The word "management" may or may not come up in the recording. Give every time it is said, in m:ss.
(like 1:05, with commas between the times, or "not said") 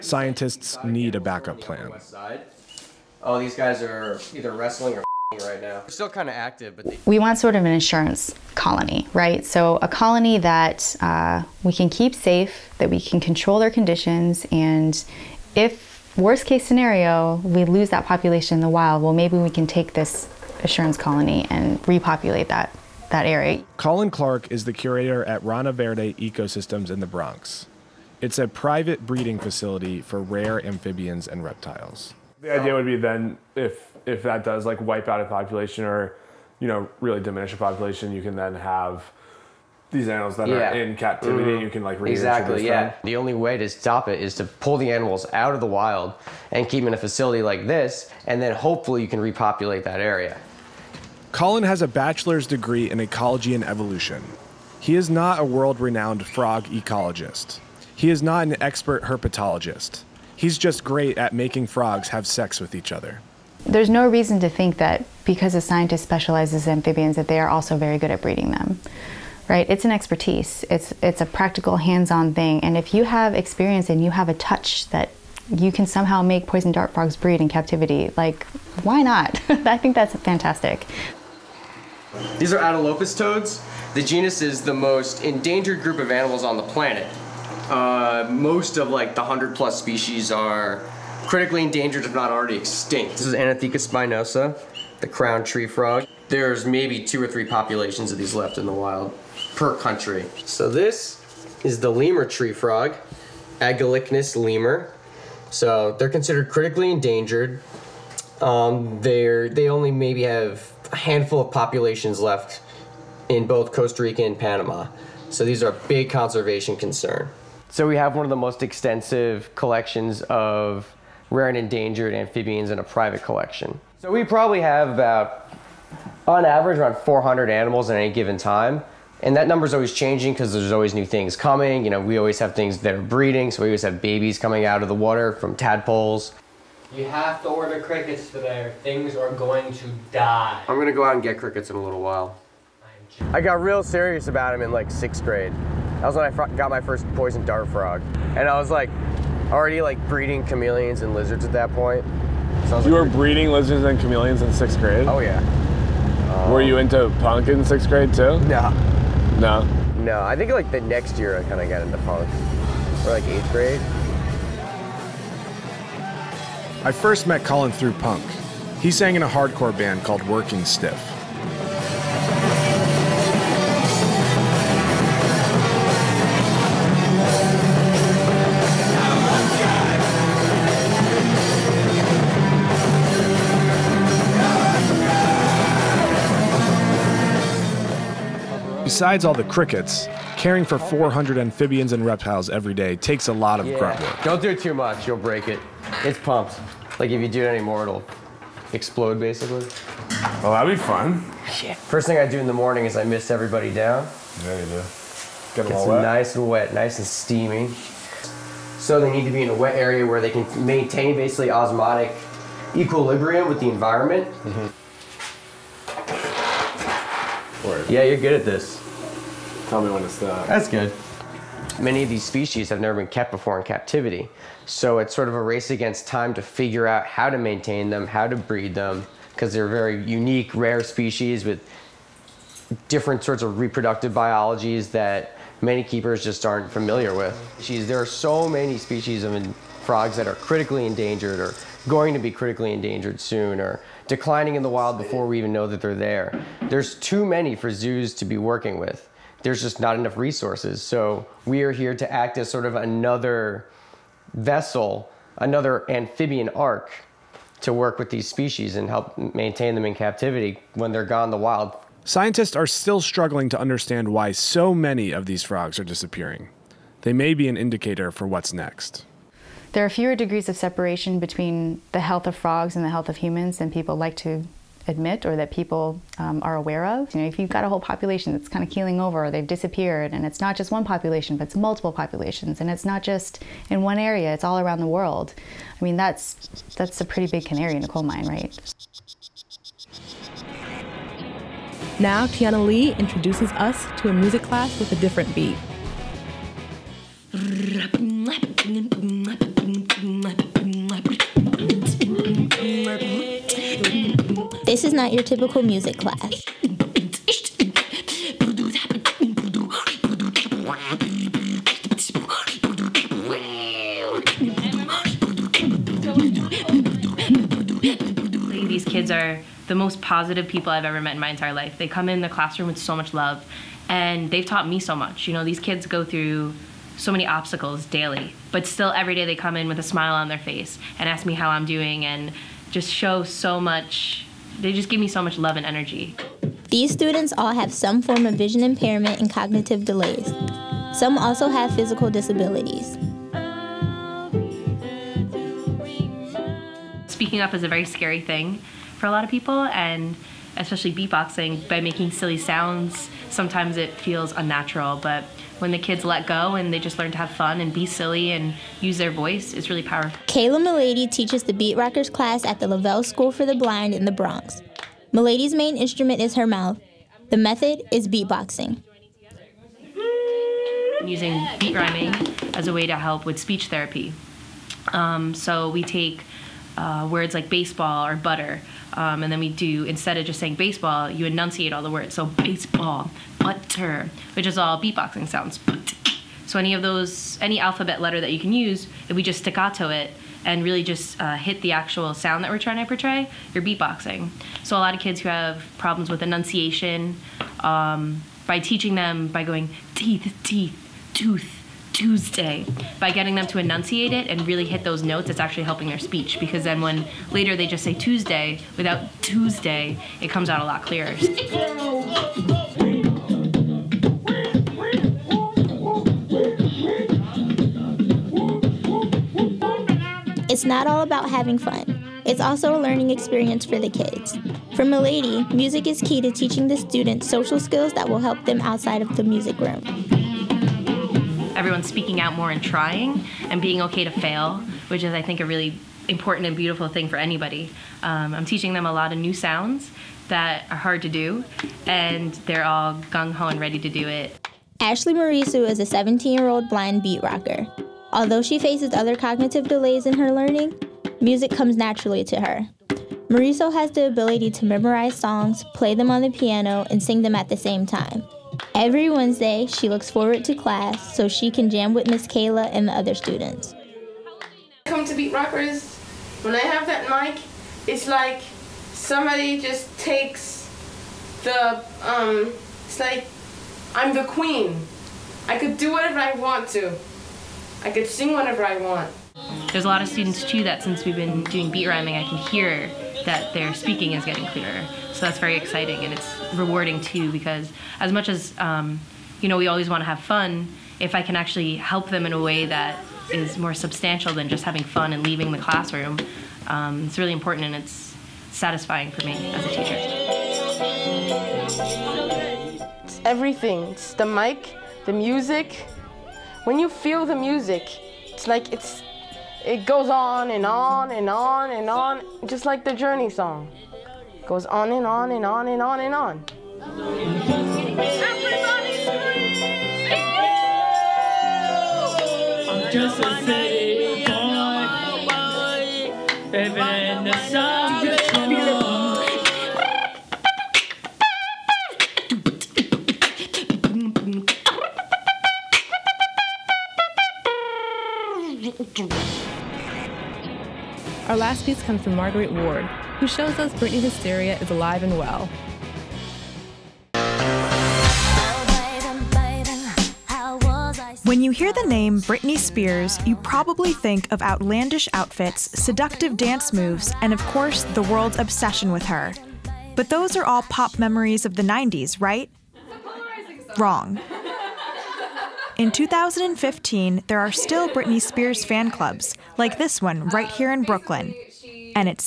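not said.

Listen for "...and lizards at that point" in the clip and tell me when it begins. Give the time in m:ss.
2:31.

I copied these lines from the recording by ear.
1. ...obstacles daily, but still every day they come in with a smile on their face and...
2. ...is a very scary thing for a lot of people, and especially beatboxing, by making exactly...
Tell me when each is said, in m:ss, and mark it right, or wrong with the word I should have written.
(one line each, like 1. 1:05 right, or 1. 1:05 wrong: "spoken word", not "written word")
1. 5:27 right
2. 5:47 wrong: "silly", not "exactly".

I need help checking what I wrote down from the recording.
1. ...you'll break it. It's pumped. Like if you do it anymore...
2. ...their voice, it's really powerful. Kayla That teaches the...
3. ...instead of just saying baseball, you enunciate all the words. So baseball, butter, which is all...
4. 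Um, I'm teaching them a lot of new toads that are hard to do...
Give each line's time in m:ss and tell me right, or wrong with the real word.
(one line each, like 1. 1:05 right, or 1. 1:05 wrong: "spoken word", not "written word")
1. 3:15 right
2. 5:58 wrong: "Milady", not "That"
3. 6:19 right
4. 7:18 wrong: "sounds", not "toads".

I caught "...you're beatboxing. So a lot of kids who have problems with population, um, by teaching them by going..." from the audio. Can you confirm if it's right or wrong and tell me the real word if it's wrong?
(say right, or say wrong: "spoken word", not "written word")
wrong: "enunciation", not "population".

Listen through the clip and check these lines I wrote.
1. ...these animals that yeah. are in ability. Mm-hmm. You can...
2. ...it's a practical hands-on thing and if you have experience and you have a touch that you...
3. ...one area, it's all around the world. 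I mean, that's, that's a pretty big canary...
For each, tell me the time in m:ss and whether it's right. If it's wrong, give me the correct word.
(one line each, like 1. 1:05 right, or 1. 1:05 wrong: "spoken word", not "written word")
1. 0:39 wrong: "captivity", not "ability"
2. 1:11 right
3. 4:43 right.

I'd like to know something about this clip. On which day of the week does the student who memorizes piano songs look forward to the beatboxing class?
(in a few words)
Wednesday.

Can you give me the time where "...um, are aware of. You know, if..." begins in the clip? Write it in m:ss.
4:36.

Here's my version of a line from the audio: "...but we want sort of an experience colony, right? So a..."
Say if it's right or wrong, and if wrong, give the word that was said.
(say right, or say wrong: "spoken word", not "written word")
wrong: "insurance", not "experience".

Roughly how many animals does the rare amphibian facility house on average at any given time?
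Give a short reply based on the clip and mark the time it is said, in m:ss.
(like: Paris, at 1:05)
400, at 2:06.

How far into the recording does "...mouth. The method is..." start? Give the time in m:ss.
6:06.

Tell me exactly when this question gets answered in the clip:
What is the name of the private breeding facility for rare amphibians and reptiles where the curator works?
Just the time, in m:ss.
0:25.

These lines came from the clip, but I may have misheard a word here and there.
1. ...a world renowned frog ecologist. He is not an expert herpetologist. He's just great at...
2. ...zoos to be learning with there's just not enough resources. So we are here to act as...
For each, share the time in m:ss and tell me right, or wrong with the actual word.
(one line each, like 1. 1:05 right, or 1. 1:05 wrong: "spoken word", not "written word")
1. 0:55 right
2. 4:07 wrong: "working", not "learning".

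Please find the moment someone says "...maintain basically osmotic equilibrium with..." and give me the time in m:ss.
3:30.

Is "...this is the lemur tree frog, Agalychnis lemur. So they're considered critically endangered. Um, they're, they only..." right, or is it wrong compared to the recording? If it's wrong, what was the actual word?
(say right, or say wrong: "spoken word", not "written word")
right.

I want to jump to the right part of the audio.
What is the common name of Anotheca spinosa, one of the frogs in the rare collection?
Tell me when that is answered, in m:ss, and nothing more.
1:34.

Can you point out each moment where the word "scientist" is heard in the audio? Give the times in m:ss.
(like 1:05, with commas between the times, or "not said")
1:05, 4:22.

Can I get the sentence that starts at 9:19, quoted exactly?
But those are all pop memories of the 90s, right?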